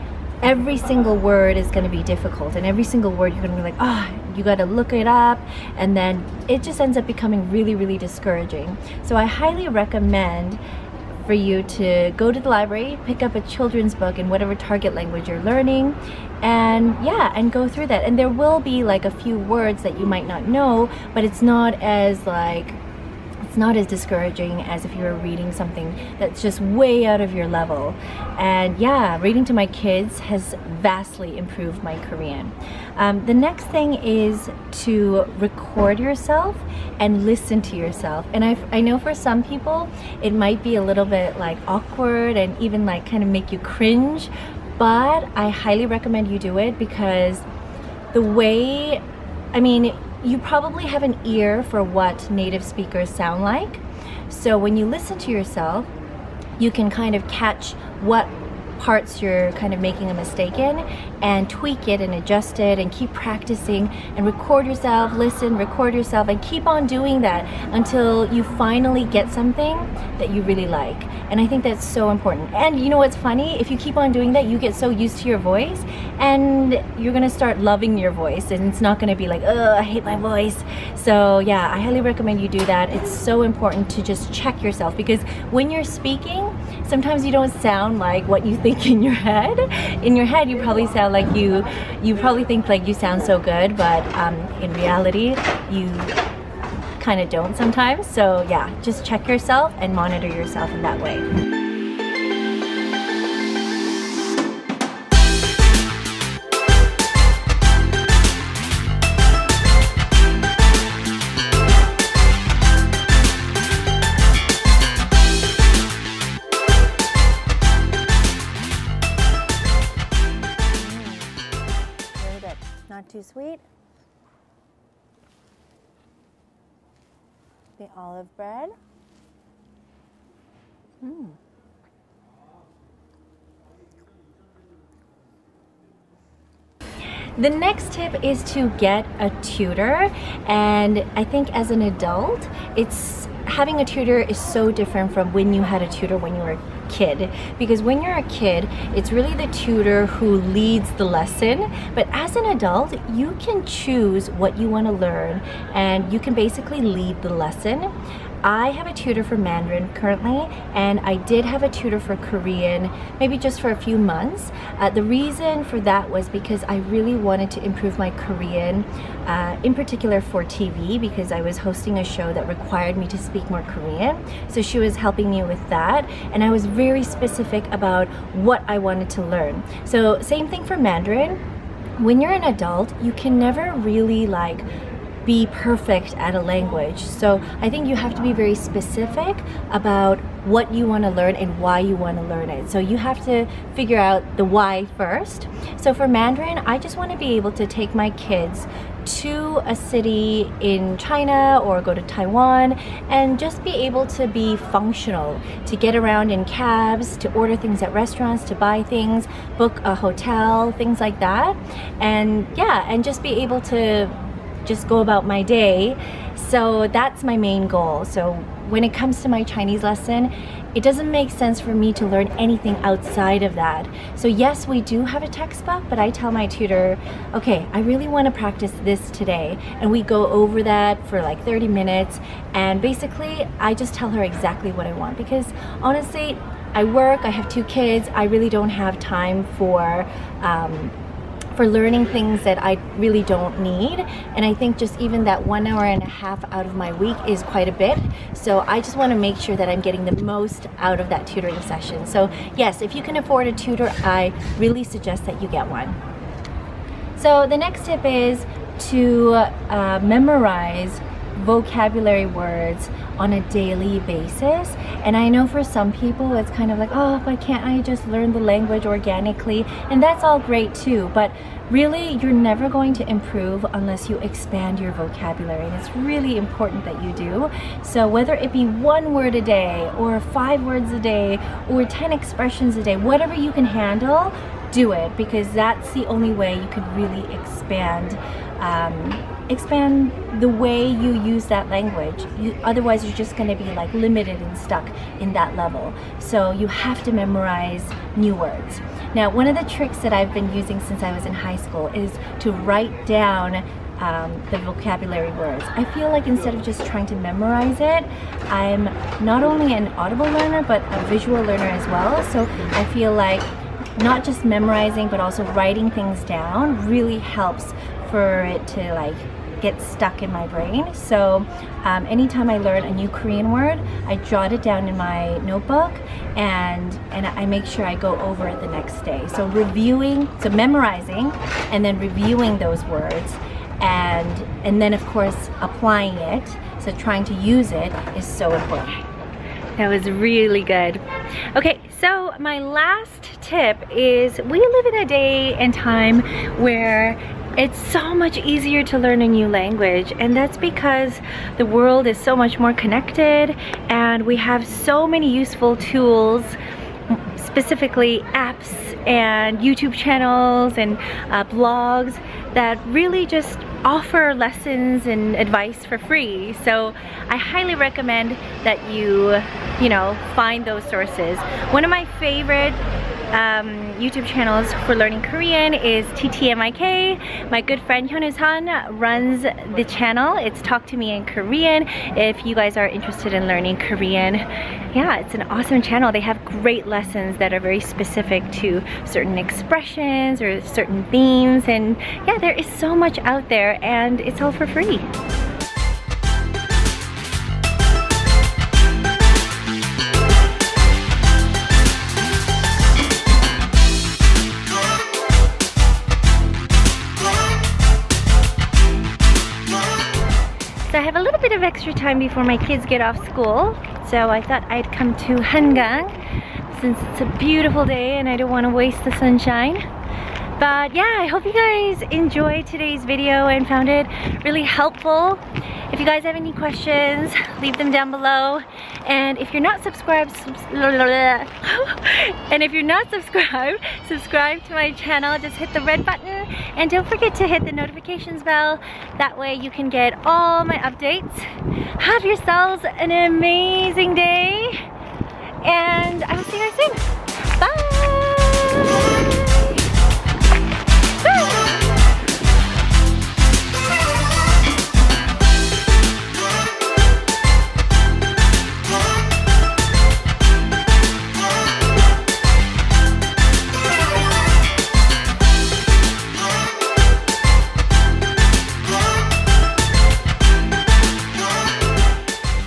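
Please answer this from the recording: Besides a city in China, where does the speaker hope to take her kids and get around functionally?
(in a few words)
Taiwan.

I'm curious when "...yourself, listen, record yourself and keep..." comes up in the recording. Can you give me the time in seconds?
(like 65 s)
64 s.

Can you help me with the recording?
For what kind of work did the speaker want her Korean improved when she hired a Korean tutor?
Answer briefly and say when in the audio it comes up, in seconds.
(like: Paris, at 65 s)
TV, at 170 s.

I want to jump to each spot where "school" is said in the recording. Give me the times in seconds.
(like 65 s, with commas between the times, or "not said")
301 s, 413 s.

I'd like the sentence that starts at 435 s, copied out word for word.
Just hit the red button and don't forget to hit the notifications bell.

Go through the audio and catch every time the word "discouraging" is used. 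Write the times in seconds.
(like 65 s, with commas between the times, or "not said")
7 s, 23 s.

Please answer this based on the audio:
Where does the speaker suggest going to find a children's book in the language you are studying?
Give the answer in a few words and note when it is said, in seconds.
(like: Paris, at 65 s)
the library, at 12 s.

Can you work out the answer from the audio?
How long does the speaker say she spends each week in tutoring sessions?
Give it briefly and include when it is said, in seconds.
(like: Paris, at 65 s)
1.5 hours, at 245 s.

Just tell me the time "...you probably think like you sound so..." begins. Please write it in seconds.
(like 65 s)
92 s.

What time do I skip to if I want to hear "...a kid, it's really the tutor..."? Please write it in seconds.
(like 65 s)
148 s.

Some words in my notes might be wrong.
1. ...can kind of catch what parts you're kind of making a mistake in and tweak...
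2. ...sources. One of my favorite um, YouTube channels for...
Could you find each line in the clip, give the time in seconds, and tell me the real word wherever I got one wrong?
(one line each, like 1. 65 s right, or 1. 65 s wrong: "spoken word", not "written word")
1. 56 s right
2. 370 s right.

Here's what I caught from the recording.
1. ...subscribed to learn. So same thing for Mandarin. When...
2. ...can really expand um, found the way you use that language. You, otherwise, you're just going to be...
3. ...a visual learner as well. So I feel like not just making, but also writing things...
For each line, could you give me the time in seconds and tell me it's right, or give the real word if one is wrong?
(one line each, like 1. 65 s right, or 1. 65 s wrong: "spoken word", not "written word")
1. 178 s wrong: "wanted", not "subscribed"
2. 286 s wrong: "expand", not "found"
3. 310 s wrong: "memorizing", not "making".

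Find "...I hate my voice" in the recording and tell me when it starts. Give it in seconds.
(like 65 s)
79 s.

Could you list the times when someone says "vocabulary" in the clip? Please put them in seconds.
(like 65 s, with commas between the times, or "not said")
261 s, 274 s, 304 s.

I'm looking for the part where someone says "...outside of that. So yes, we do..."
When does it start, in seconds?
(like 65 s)
222 s.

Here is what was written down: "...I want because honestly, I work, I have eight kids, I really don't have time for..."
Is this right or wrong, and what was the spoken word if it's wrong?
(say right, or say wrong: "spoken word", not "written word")
wrong: "two", not "eight".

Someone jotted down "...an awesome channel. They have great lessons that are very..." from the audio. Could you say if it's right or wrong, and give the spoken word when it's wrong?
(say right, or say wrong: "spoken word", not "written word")
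right.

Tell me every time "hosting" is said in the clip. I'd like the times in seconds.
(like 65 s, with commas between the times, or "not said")
171 s.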